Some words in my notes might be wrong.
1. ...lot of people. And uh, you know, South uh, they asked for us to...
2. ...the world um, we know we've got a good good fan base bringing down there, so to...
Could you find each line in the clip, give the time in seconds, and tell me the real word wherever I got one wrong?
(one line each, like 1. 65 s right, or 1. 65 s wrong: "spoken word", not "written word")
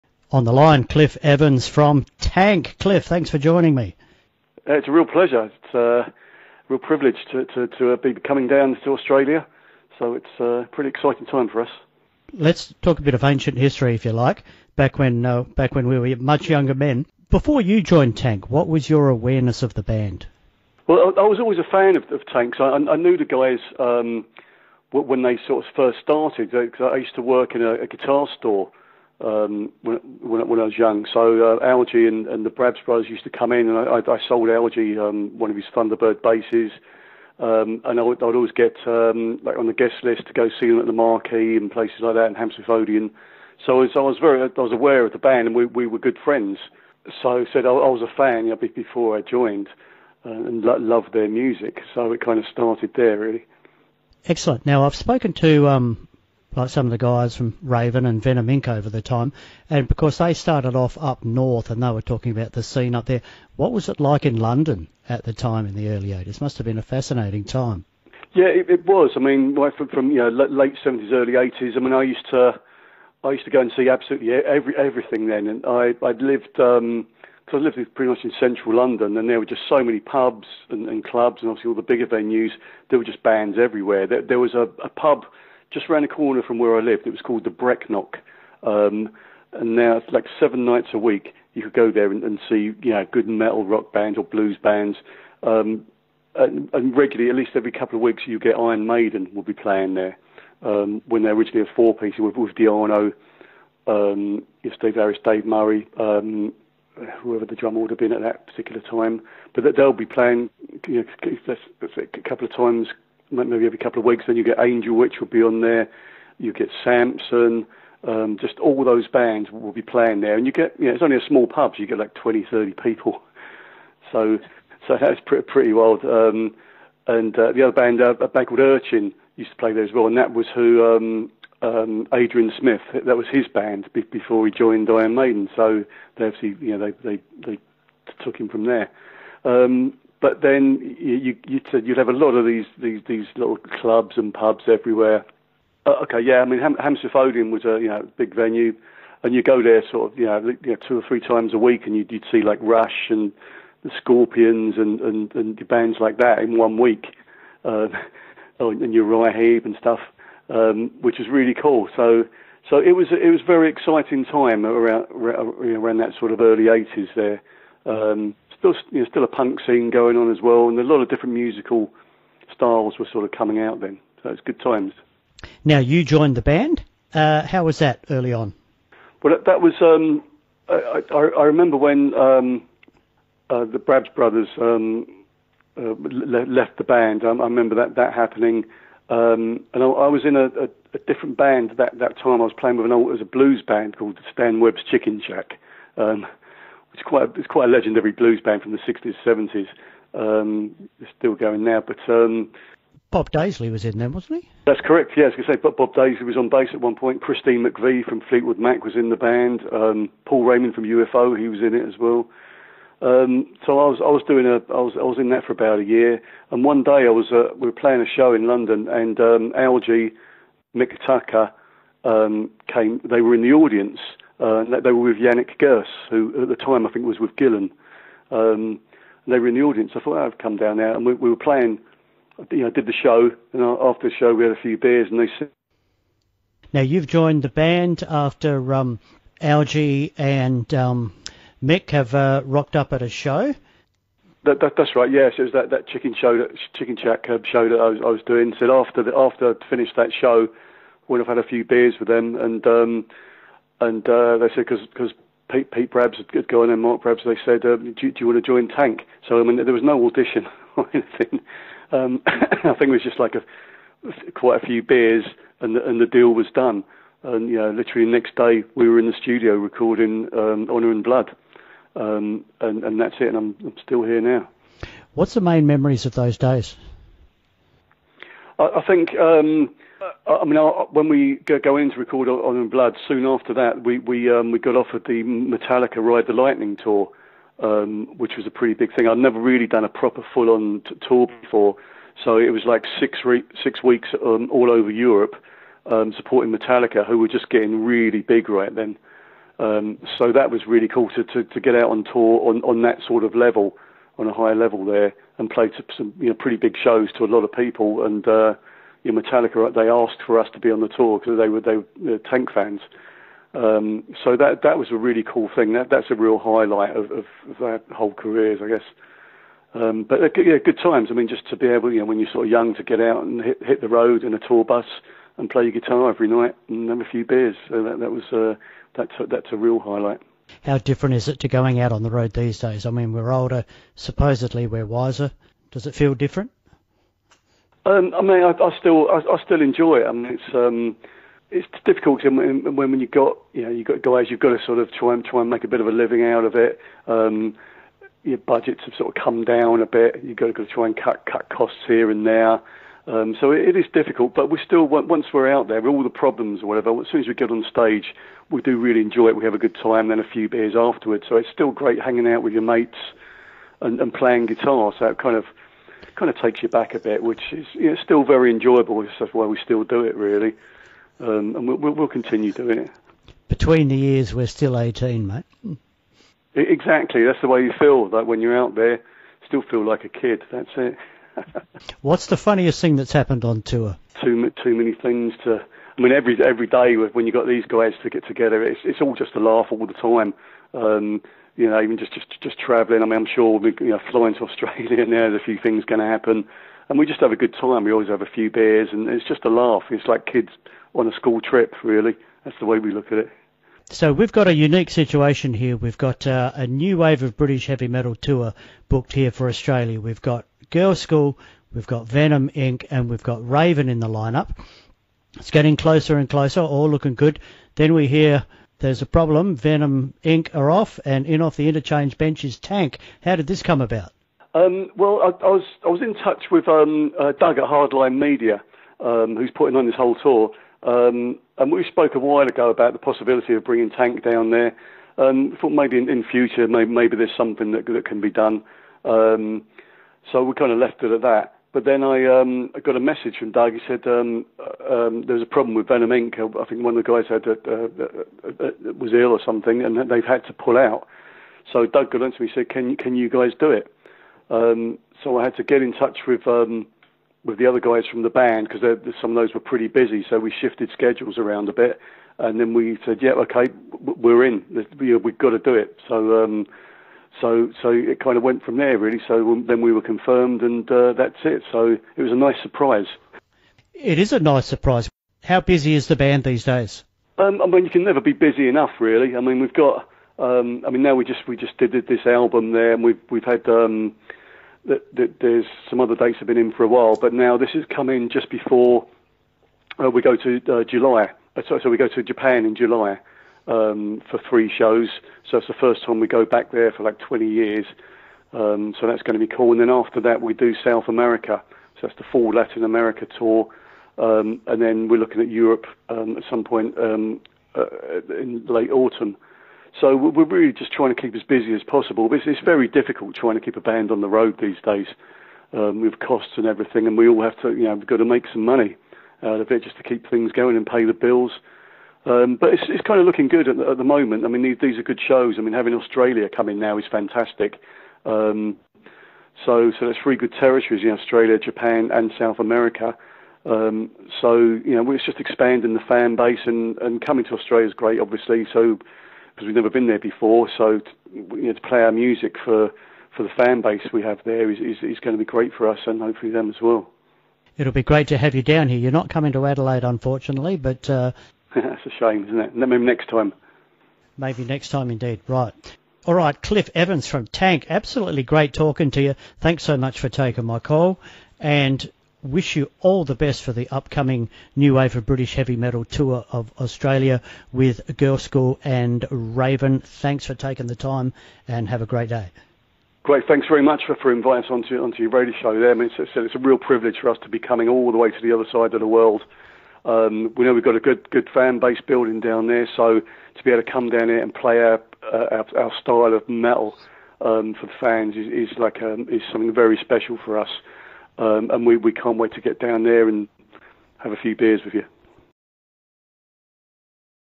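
1. 307 s wrong: "Metallica", not "South"
2. 578 s wrong: "building", not "bringing".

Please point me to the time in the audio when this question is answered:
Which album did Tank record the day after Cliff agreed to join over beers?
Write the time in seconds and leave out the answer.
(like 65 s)
270 s.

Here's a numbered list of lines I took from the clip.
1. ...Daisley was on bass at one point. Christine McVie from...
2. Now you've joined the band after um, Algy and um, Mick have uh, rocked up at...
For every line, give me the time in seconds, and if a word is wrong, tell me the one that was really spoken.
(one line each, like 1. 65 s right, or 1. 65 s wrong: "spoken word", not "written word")
1. 205 s right
2. 236 s right.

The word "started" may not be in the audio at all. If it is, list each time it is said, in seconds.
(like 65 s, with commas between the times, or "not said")
26 s, 52 s, 60 s.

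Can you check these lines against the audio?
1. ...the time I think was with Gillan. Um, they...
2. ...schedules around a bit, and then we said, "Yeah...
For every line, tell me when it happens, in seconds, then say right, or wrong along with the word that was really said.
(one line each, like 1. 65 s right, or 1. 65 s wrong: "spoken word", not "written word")
1. 226 s right
2. 460 s right.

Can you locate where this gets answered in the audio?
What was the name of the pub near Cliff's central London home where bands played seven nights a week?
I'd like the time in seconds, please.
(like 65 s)
87 s.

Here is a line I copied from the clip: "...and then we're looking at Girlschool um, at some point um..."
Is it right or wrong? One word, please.
wrong.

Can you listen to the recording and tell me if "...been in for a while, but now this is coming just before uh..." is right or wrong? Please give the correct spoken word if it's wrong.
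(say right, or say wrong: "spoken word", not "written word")
right.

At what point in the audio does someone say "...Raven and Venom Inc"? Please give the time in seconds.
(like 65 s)
57 s.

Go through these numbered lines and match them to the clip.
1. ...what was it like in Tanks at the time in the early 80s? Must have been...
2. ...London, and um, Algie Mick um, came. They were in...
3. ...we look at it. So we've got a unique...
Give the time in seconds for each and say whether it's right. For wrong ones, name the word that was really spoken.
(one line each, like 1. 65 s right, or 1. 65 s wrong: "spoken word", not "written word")
1. 63 s wrong: "London", not "Tanks"
2. 218 s wrong: "Mikataka", not "Mick"
3. 402 s right.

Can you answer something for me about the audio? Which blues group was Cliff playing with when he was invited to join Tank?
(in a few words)
Stan Webb's Chicken Shack.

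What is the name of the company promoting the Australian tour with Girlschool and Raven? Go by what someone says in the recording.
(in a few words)
Hardline Media.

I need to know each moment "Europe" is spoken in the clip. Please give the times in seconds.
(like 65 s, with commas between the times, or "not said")
294 s, 505 s.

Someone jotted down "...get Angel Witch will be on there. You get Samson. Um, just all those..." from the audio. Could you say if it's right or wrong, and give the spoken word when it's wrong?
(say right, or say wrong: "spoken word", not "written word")
right.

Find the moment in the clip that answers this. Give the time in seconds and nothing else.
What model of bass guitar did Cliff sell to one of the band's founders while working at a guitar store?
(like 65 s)
35 s.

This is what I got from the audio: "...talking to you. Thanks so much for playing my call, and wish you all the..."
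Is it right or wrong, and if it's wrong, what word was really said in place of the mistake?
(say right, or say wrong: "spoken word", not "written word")
wrong: "taking", not "playing".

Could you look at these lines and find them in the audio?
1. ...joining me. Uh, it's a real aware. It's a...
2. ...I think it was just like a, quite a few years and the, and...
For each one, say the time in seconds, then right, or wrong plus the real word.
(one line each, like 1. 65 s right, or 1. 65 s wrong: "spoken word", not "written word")
1. 3 s wrong: "pleasure", not "aware"
2. 262 s wrong: "beers", not "years".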